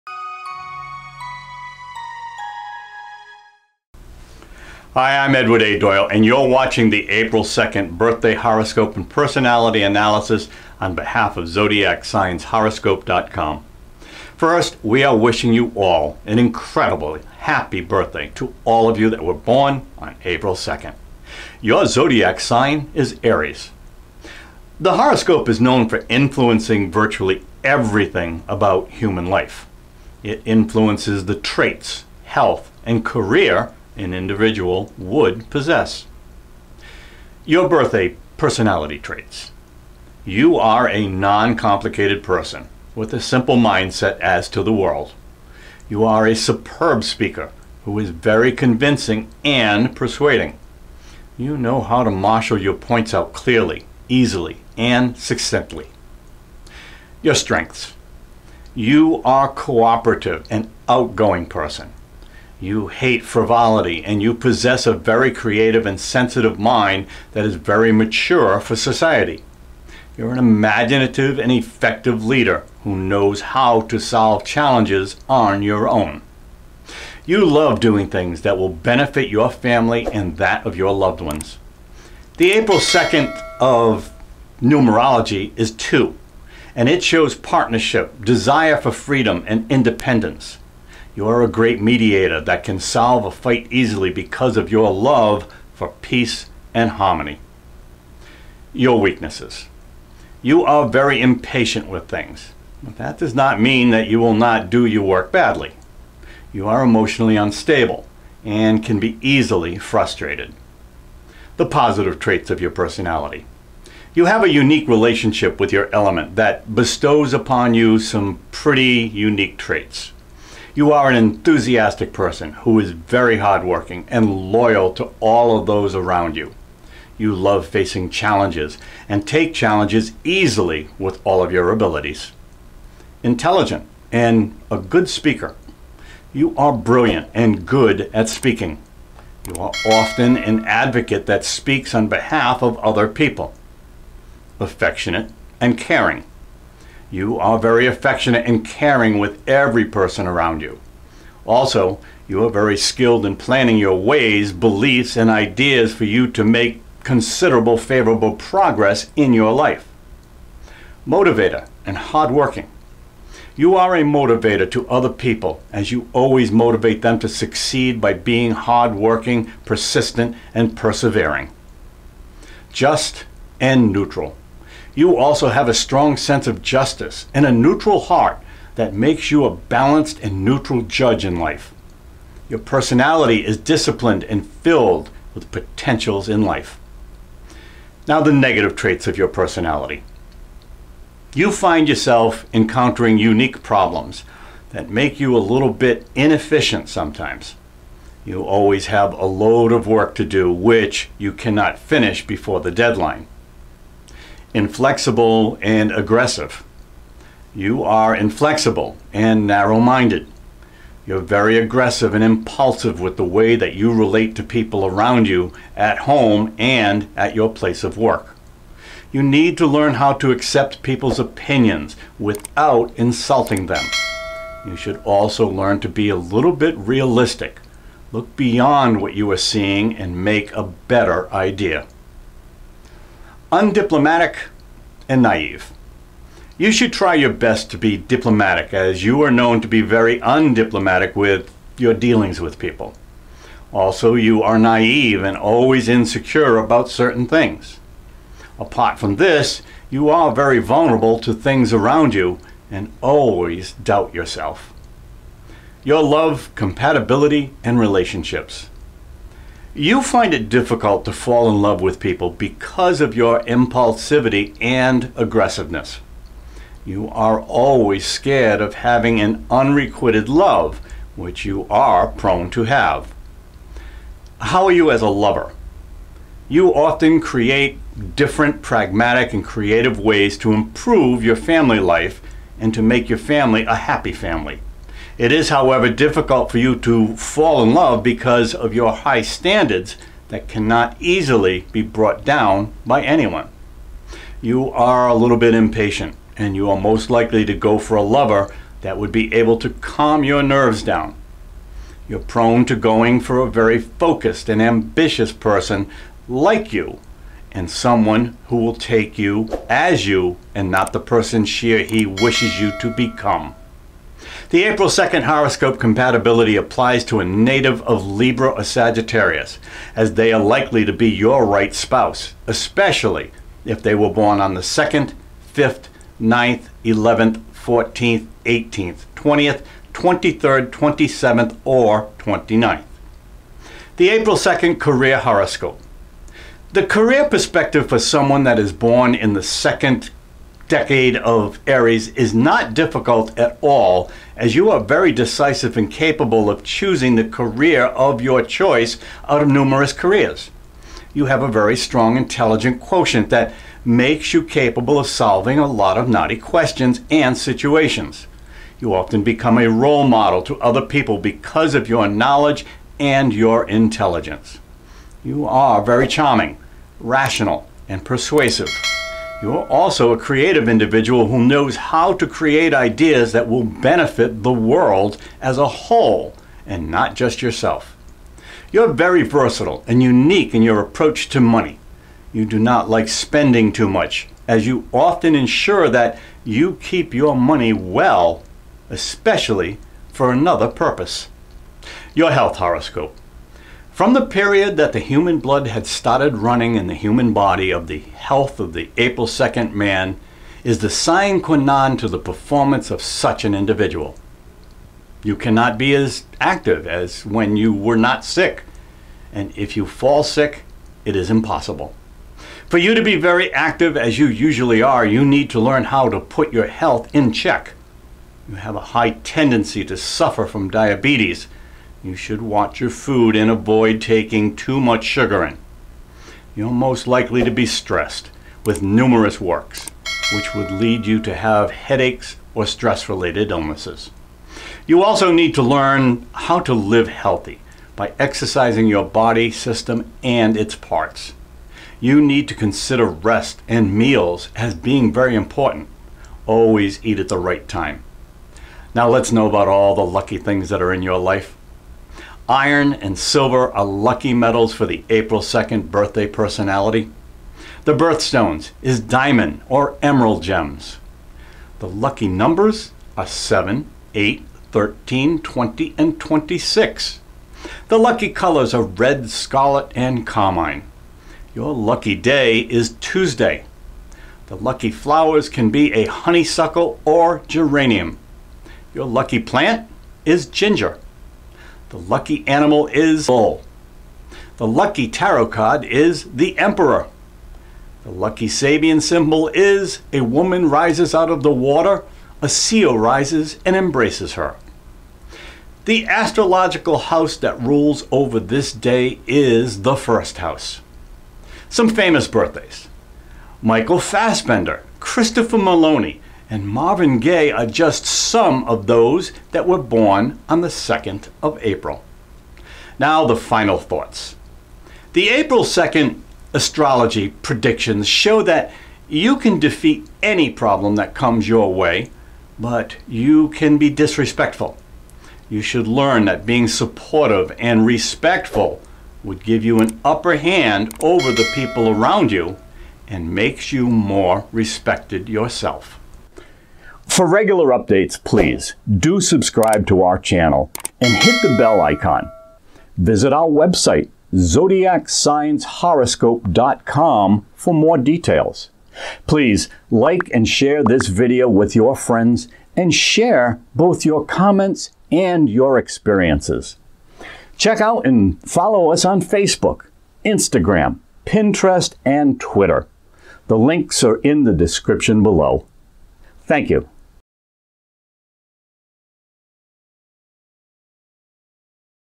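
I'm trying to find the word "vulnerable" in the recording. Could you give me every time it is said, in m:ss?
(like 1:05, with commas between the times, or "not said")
4:10.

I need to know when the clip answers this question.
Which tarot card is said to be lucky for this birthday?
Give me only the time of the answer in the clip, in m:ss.
8:06.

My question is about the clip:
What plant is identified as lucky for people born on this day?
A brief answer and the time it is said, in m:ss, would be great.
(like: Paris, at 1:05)
Ginger, at 8:00.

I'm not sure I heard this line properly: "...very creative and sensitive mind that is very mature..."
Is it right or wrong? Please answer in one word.
right.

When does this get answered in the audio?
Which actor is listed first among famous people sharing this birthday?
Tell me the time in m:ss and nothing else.
8:23.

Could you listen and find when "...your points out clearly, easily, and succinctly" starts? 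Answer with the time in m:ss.
0:52.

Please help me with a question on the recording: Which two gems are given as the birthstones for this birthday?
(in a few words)
Diamond or emerald.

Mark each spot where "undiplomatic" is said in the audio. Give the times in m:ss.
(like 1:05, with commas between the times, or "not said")
3:53, 4:00.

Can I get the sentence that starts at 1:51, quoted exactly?
The positive traits of your personality.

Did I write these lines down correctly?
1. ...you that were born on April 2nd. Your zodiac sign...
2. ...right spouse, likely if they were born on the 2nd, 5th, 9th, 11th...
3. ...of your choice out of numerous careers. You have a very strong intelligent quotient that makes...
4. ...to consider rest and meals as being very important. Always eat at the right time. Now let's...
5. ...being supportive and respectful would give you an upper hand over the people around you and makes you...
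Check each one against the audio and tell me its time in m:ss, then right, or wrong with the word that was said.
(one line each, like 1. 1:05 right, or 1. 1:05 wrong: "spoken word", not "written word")
1. 0:18 right
2. 5:21 wrong: "especially", not "likely"
3. 5:47 right
4. 7:22 right
5. 8:46 right.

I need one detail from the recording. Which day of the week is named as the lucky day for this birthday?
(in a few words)
Tuesday.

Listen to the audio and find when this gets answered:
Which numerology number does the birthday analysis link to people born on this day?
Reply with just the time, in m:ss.
1:22.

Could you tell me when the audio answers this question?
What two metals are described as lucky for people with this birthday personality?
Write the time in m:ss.
7:32.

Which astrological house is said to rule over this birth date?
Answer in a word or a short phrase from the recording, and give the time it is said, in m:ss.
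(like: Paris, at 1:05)
The first house, at 8:19.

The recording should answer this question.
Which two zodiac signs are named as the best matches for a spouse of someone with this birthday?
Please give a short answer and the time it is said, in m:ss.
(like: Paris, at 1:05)
Libra or Sagittarius, at 5:18.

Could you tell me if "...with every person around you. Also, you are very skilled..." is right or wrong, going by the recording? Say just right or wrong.
right.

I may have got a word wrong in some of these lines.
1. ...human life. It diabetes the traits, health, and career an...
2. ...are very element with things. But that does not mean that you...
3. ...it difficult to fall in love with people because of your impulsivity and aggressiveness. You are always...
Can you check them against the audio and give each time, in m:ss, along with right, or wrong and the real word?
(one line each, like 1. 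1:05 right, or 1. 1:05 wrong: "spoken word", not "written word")
1. 0:28 wrong: "influences", not "diabetes"
2. 1:40 wrong: "impatient", not "element"
3. 4:20 right.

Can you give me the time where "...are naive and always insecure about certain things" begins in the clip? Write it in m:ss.
4:04.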